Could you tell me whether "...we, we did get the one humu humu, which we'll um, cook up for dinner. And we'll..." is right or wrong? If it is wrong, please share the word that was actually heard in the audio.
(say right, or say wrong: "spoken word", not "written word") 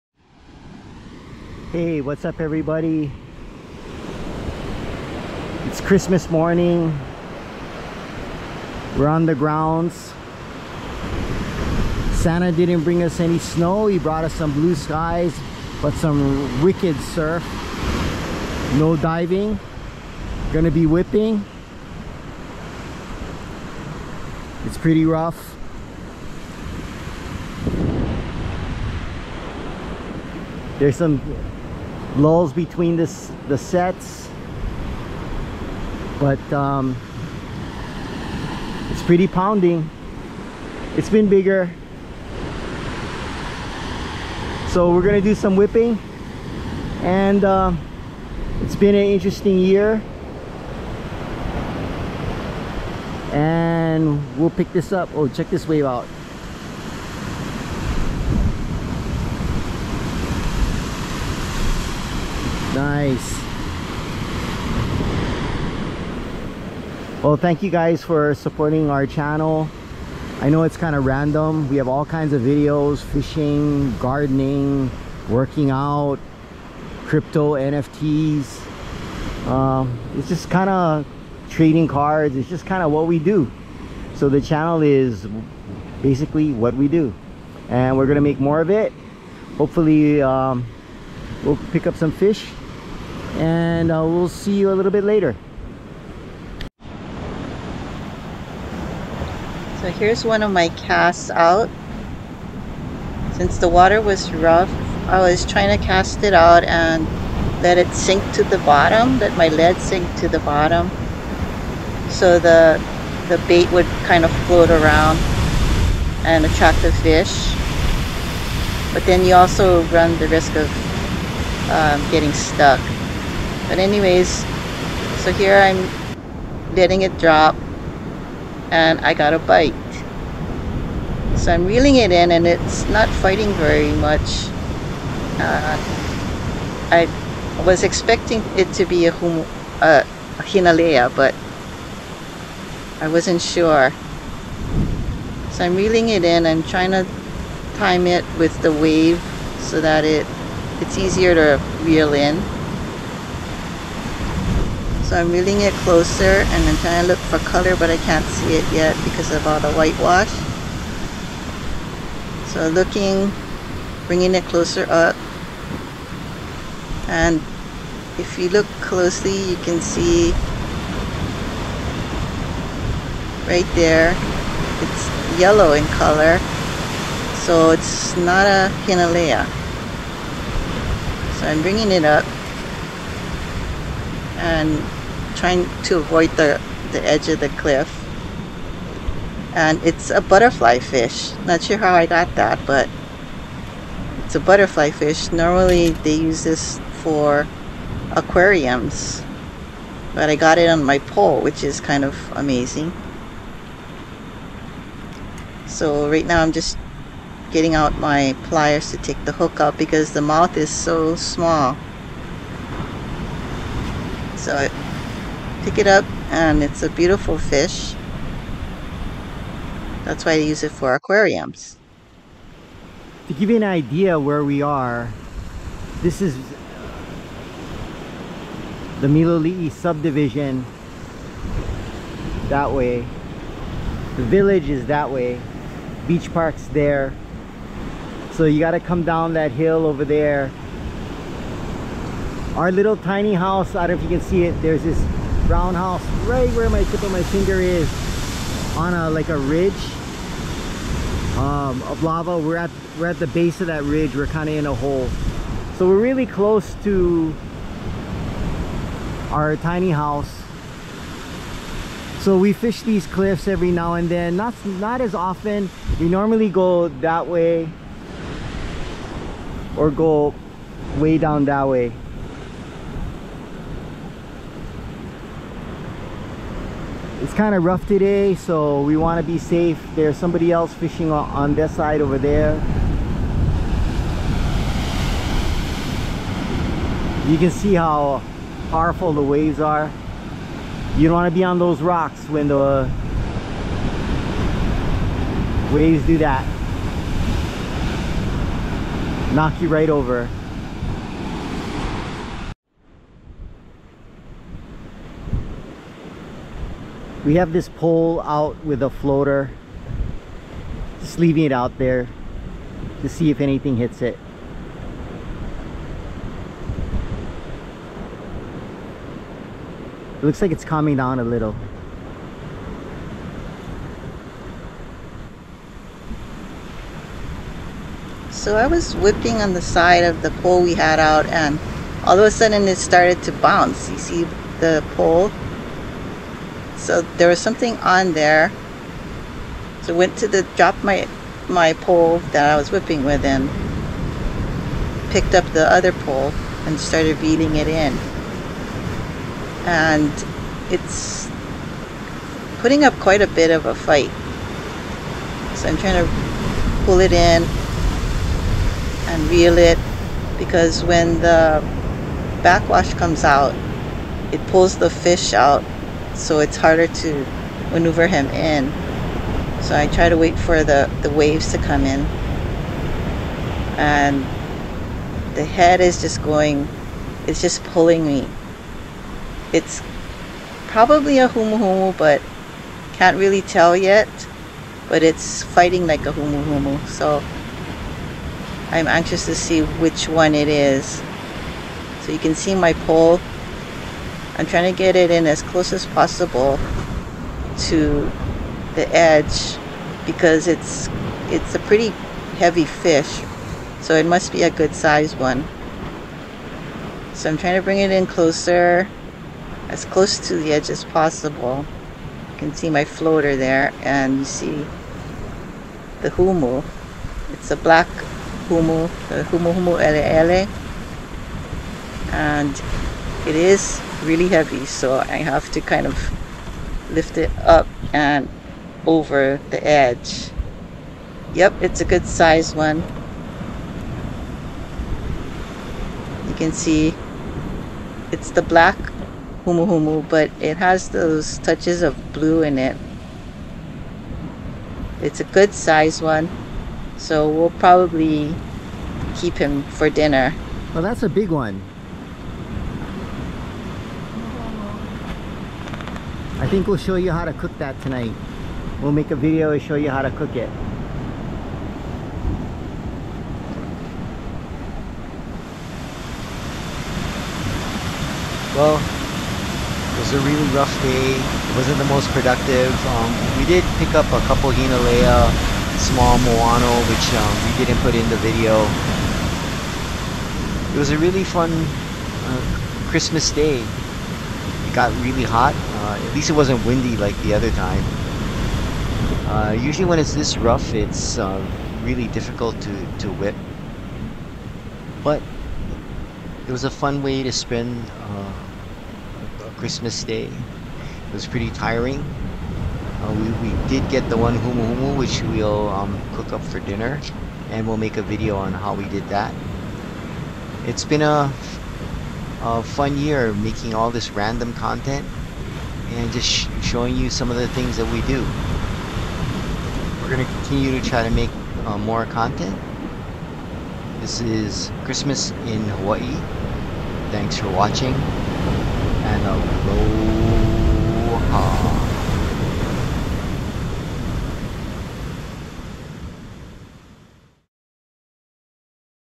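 right.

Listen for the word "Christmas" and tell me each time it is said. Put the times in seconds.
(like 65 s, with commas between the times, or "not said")
5 s, 482 s, 499 s, 524 s.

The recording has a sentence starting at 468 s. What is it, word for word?
Well, it was a really rough day.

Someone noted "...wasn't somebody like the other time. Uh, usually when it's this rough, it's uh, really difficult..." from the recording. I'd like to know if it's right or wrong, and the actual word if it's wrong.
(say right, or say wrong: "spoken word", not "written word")
wrong: "windy", not "somebody".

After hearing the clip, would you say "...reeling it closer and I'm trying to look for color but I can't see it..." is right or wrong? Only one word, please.
right.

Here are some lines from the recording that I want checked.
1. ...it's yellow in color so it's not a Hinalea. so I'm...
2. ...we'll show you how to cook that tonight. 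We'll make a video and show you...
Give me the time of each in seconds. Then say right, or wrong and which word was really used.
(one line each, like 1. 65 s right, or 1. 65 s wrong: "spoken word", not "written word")
1. 174 s right
2. 456 s right.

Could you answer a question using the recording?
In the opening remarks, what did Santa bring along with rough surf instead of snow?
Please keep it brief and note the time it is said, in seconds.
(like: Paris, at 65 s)
Blue skies, at 14 s.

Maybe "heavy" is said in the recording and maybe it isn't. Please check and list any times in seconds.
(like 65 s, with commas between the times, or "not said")
402 s, 424 s.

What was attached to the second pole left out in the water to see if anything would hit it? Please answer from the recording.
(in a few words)
A floater.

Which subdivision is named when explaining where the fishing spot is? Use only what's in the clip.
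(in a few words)
Miloli'i.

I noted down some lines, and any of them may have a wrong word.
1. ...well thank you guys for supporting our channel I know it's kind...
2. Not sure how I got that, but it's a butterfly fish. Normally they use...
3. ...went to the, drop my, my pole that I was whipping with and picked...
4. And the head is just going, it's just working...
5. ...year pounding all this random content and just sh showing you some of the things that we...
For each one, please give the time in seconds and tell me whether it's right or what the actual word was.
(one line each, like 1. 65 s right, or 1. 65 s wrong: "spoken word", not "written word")
1. 67 s right
2. 191 s right
3. 339 s right
4. 373 s wrong: "pulling", not "working"
5. 512 s wrong: "making", not "pounding".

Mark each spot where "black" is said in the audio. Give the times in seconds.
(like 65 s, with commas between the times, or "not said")
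417 s, 438 s.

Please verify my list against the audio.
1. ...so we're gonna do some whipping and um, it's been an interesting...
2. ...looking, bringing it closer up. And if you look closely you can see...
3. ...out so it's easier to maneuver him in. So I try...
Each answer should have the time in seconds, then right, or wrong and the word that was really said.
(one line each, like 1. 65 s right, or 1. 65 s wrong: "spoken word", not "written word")
1. 44 s right
2. 162 s right
3. 365 s wrong: "harder", not "easier".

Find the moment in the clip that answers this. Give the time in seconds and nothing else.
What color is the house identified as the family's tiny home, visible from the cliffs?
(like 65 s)
245 s.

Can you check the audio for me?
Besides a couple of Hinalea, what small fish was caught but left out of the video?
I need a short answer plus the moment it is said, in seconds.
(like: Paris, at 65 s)
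Moano, at 476 s.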